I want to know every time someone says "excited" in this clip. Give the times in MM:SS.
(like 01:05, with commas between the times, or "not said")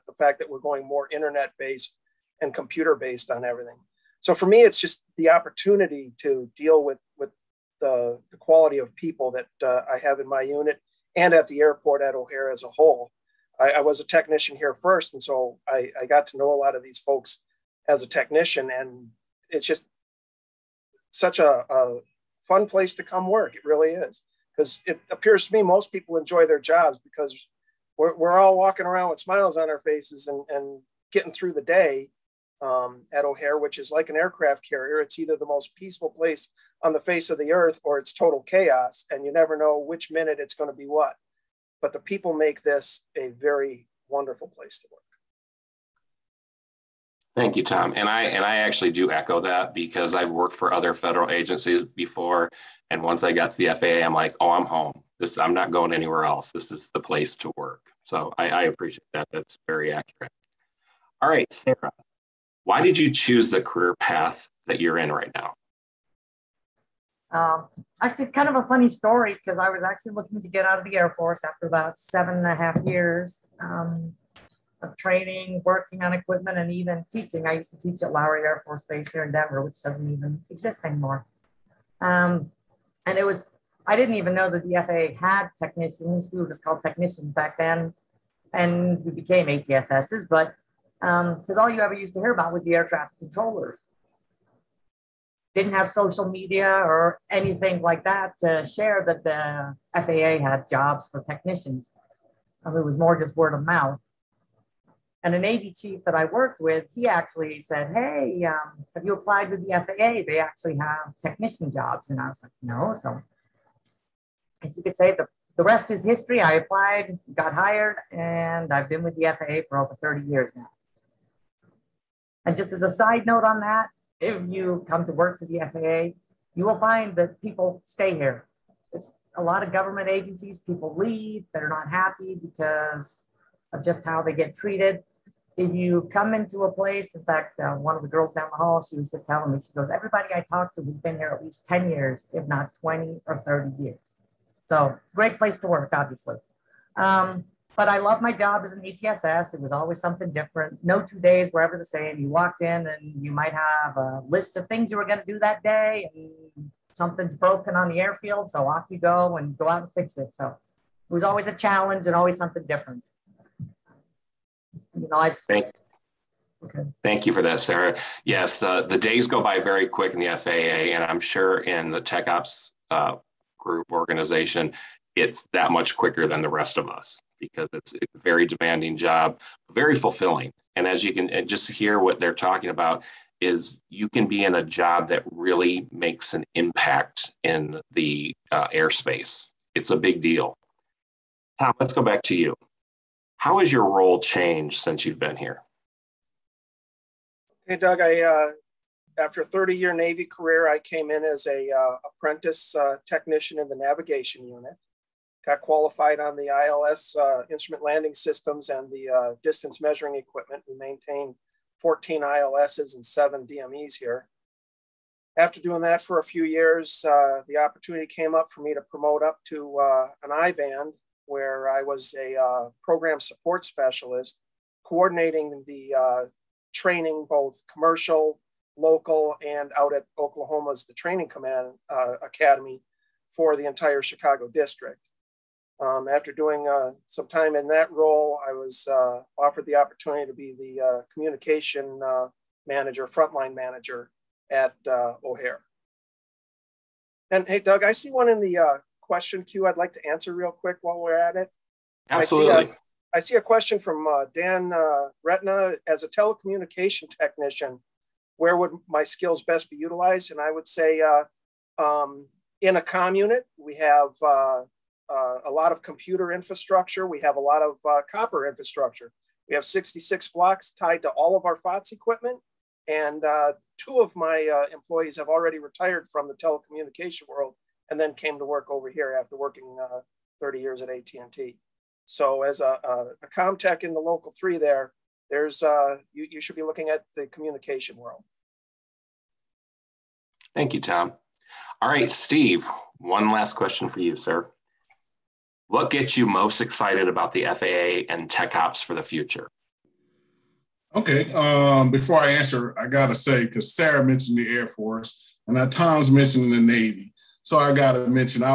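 04:56.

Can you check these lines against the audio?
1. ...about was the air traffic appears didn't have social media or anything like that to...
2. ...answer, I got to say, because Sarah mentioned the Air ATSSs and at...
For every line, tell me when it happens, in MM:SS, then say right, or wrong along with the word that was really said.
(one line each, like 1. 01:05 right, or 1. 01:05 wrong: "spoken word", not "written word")
1. 01:32 wrong: "controllers", not "appears"
2. 05:02 wrong: "Force", not "ATSSs".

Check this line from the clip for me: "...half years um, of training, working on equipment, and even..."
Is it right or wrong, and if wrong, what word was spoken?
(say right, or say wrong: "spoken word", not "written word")
right.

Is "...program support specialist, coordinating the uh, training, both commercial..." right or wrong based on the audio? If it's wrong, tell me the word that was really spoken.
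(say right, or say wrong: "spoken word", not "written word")
right.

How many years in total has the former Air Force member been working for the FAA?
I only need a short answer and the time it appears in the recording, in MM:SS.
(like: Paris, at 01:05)
over 30 years, at 01:59.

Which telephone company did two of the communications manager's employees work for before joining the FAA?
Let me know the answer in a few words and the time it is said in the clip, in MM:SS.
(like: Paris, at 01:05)
AT&T, at 04:40.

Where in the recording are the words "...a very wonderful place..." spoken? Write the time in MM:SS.
00:43.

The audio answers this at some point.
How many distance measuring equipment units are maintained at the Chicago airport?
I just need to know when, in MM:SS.
03:33.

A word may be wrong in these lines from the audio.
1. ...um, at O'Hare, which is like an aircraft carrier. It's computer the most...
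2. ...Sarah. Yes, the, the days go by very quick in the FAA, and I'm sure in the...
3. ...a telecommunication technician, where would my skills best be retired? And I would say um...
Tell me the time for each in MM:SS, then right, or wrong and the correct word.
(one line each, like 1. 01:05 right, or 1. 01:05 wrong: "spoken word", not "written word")
1. 00:32 wrong: "either", not "computer"
2. 02:47 right
3. 04:16 wrong: "utilized", not "retired".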